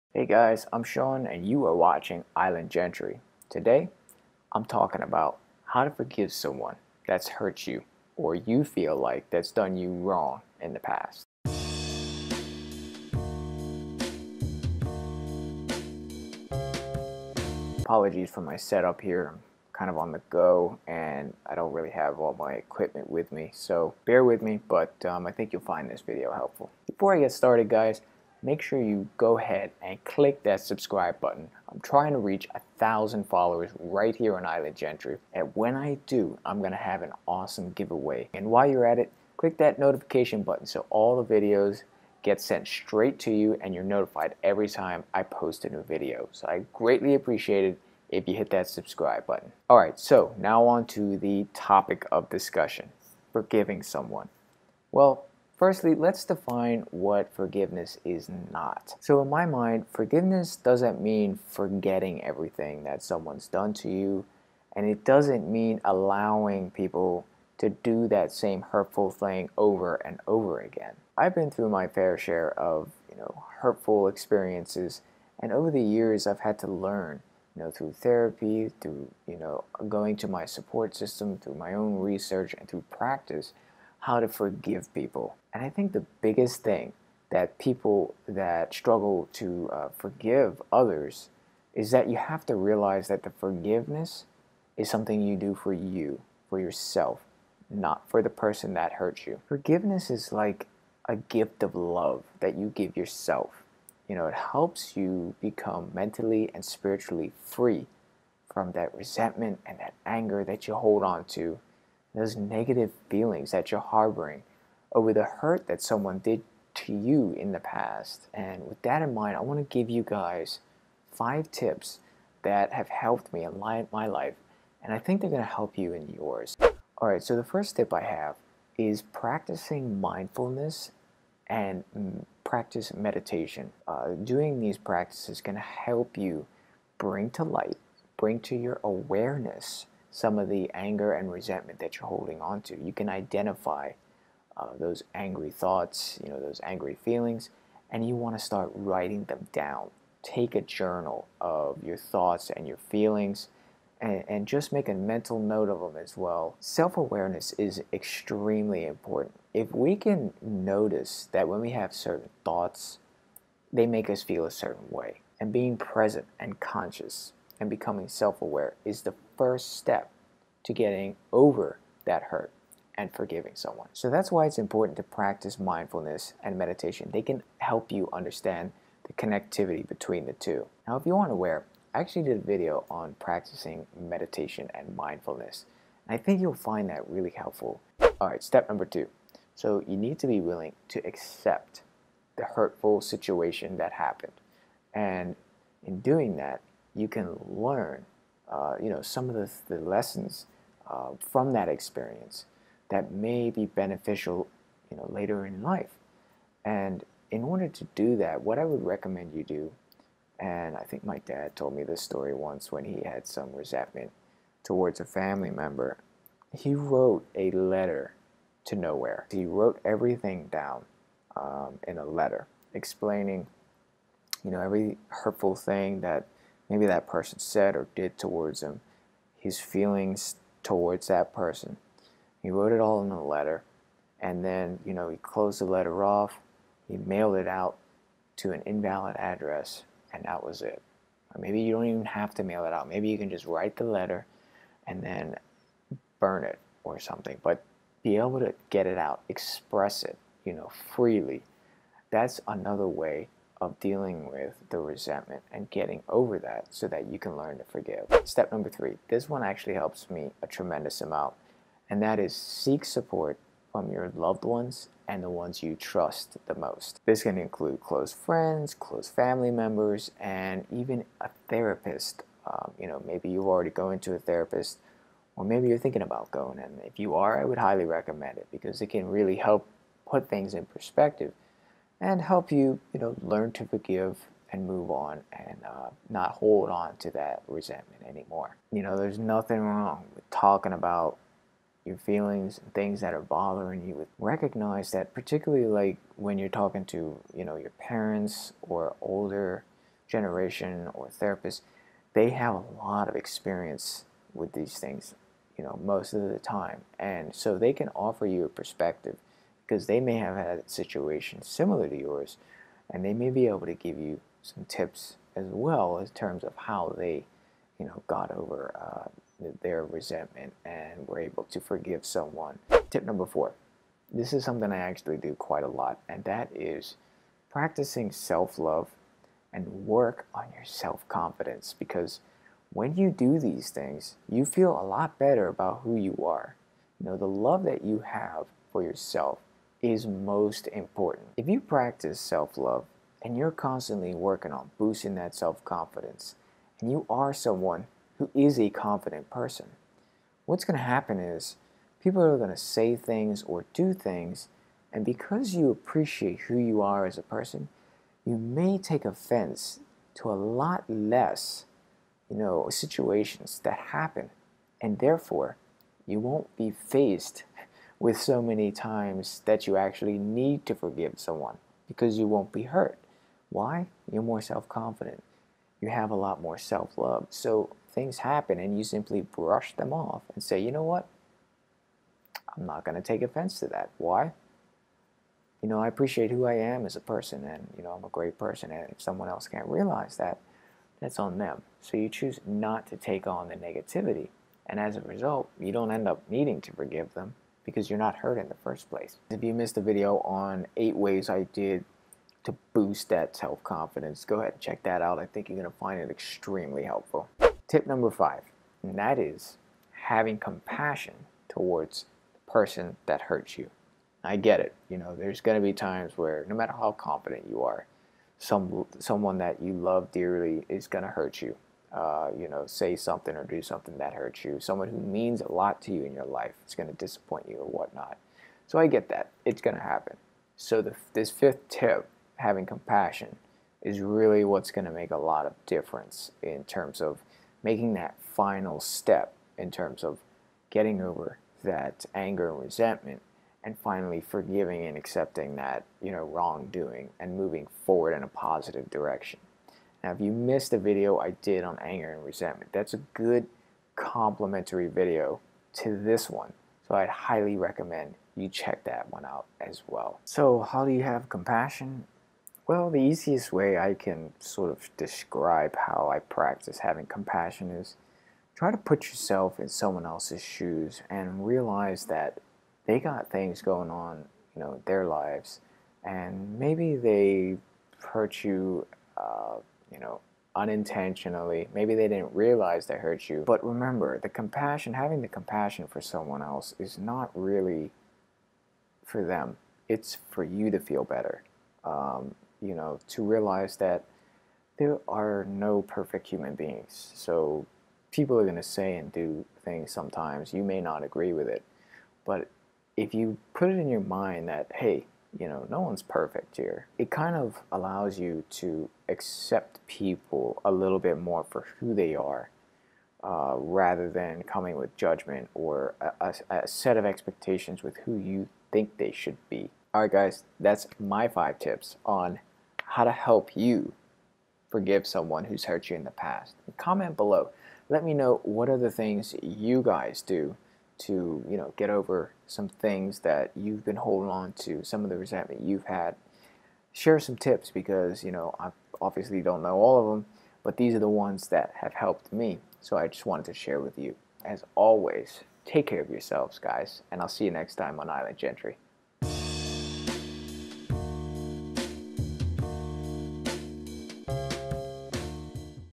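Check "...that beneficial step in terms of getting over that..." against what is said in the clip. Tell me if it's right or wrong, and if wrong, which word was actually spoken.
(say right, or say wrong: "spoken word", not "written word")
wrong: "final", not "beneficial".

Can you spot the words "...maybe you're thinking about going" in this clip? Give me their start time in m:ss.
4:35.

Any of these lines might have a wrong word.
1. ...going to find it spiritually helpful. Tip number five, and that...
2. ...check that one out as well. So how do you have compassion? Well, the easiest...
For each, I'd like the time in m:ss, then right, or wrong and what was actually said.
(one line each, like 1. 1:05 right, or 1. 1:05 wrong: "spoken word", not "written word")
1. 6:45 wrong: "extremely", not "spiritually"
2. 7:38 right.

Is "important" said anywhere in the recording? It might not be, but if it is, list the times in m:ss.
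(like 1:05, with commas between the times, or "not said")
2:38, 2:54, 5:40.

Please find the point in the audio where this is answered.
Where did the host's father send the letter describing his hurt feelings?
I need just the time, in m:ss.
3:58.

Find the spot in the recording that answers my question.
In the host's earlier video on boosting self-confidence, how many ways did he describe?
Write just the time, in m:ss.
6:40.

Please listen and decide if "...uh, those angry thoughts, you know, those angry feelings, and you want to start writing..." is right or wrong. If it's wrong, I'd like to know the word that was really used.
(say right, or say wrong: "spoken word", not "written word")
right.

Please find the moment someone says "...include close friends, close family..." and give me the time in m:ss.
4:27.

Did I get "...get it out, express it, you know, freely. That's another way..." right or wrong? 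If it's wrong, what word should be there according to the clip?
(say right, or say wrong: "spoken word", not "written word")
right.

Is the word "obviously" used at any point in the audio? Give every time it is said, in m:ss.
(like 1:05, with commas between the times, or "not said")
8:59.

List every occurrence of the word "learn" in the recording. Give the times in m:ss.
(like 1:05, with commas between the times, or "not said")
1:16, 3:17, 4:17, 4:43.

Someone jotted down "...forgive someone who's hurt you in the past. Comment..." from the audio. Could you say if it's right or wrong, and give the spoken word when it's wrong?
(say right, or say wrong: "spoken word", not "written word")
right.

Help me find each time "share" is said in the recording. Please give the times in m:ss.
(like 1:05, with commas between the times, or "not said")
1:12, 8:56, 9:03.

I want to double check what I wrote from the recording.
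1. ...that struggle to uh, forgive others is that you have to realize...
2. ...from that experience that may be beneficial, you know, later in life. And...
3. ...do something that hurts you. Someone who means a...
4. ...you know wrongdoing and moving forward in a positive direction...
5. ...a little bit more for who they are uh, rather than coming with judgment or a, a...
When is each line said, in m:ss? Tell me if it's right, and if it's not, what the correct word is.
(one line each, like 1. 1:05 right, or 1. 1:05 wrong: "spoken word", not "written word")
1. 1:28 right
2. 3:21 right
3. 7:03 right
4. 7:26 right
5. 8:30 right.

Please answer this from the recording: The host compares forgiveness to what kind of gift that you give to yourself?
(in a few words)
A gift of love.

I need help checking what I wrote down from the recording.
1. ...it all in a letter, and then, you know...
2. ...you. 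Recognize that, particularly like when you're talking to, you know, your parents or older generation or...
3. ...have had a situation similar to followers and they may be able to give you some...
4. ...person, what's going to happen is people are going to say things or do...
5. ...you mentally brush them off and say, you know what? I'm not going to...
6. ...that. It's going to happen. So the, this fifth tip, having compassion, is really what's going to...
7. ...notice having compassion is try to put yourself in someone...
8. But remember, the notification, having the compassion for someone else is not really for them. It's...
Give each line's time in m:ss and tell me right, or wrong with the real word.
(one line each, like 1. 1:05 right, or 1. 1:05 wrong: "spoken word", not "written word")
1. 3:52 right
2. 4:53 right
3. 5:10 wrong: "yours", not "followers"
4. 5:49 right
5. 6:18 wrong: "simply", not "mentally"
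6. 7:09 right
7. 7:46 wrong: "practice", not "notice"
8. 8:03 wrong: "compassion", not "notification".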